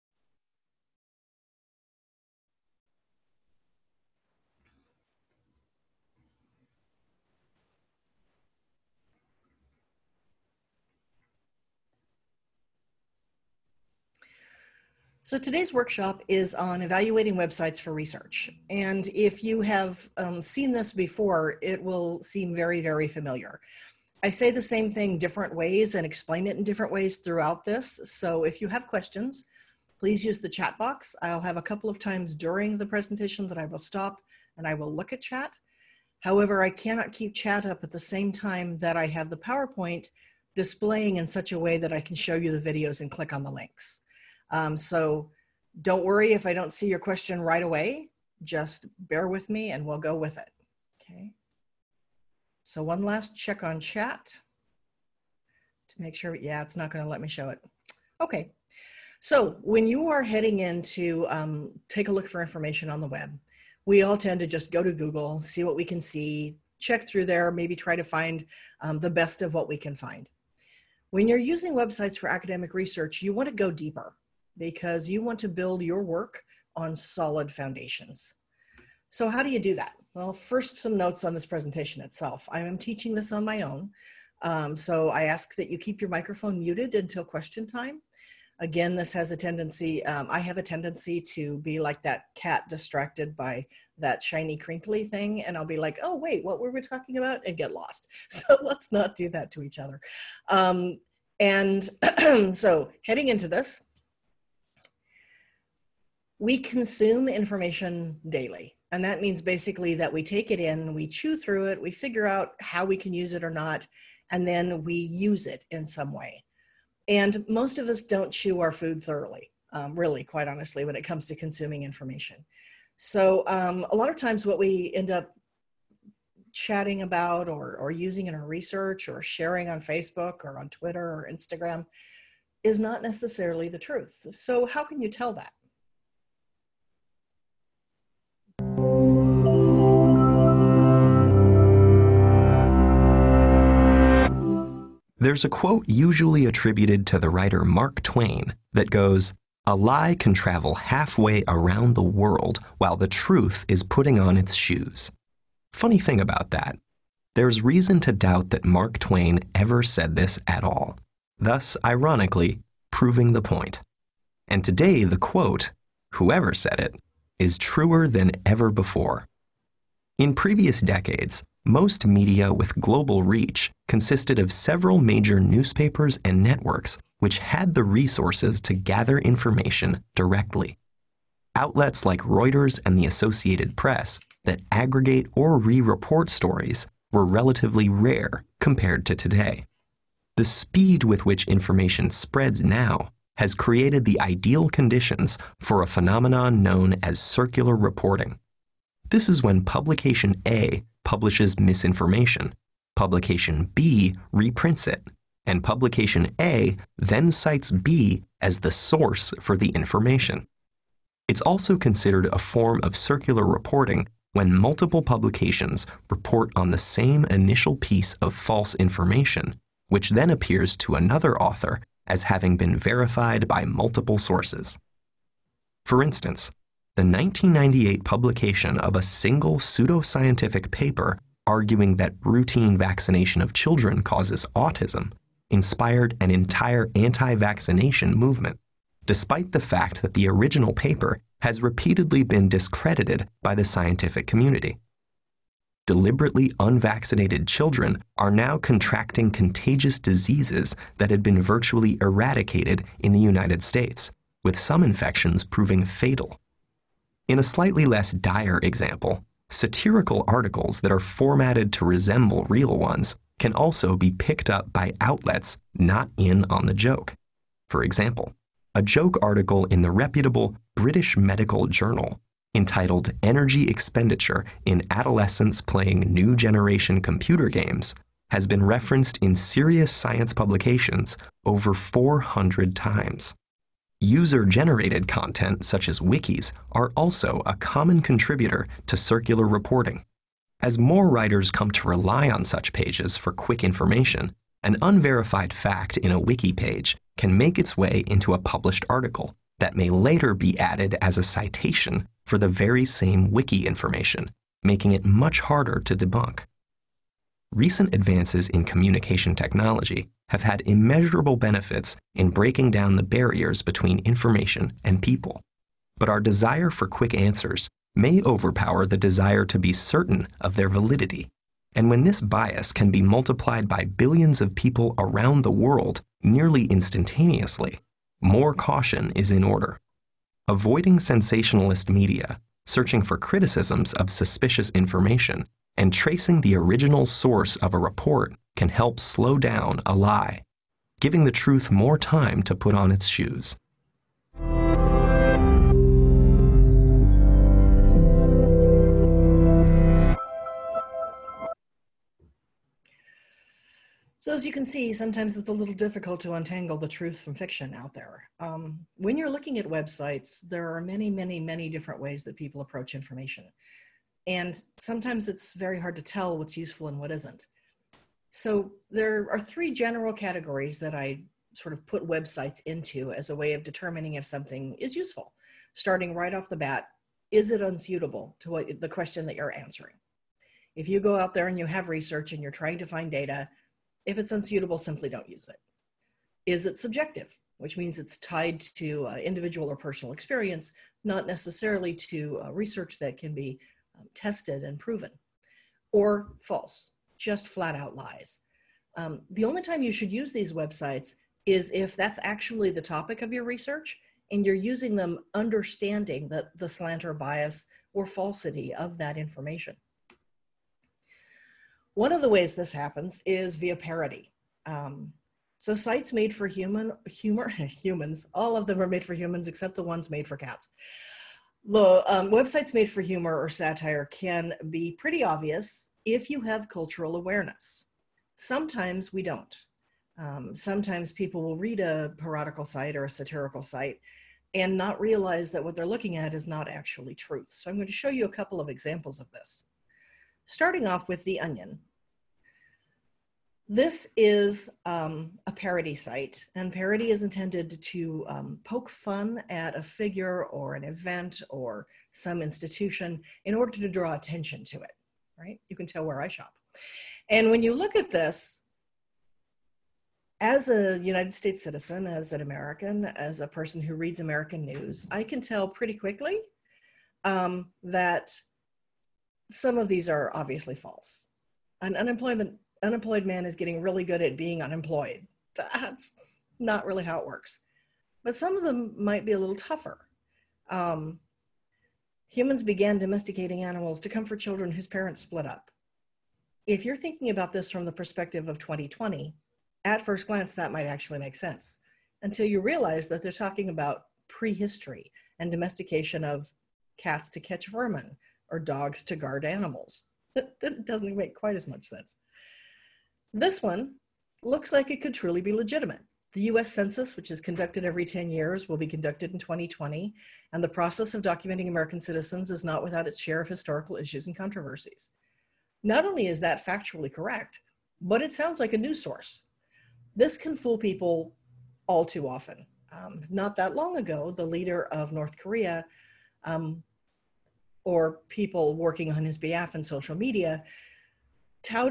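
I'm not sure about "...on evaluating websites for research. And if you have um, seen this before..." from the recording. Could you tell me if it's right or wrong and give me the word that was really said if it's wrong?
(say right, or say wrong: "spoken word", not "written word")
right.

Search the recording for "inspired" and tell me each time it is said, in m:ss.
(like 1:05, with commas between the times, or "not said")
3:55.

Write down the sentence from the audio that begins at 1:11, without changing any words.
When you're using websites for academic research, you want to go deeper because you want to build your work on solid foundations.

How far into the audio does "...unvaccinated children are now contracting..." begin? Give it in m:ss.
4:06.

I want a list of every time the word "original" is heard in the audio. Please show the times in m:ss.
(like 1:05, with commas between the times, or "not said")
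4:00, 5:36.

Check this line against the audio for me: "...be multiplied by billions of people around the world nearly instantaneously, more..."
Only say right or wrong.
right.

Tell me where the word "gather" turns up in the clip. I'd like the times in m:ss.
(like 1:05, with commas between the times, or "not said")
2:58.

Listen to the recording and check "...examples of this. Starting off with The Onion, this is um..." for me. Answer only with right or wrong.
right.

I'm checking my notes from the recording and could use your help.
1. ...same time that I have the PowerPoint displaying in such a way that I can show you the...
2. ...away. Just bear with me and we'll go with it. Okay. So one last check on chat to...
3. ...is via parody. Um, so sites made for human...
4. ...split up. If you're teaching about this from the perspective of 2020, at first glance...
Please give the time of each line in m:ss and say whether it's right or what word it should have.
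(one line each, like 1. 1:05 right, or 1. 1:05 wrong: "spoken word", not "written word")
1. 0:37 right
2. 0:47 right
3. 6:53 right
4. 8:05 wrong: "thinking", not "teaching".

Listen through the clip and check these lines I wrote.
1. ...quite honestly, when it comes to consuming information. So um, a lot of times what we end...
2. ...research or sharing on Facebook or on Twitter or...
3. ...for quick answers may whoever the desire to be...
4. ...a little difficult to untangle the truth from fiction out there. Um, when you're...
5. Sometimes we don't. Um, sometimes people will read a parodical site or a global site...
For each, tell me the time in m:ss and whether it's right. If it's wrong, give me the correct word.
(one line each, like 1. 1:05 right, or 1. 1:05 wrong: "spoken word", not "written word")
1. 2:00 right
2. 2:08 right
3. 5:16 wrong: "overpower", not "whoever"
4. 5:55 right
5. 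7:08 wrong: "satirical", not "global".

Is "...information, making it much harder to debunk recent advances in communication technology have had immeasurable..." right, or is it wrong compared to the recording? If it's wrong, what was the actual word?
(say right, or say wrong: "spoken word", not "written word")
right.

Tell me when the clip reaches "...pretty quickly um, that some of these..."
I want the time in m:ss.
7:45.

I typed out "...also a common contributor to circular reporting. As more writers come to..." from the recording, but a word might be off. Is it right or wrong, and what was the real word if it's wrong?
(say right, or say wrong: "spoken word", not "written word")
right.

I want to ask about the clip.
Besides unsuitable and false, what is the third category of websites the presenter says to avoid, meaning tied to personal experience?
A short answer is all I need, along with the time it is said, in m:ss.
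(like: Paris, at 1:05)
subjective, at 6:26.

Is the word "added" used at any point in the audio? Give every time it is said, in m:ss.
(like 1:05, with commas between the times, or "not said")
5:00.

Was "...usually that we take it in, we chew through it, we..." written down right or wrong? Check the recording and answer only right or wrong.
wrong.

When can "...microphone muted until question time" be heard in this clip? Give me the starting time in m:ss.
1:26.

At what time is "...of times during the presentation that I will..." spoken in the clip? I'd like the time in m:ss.
0:31.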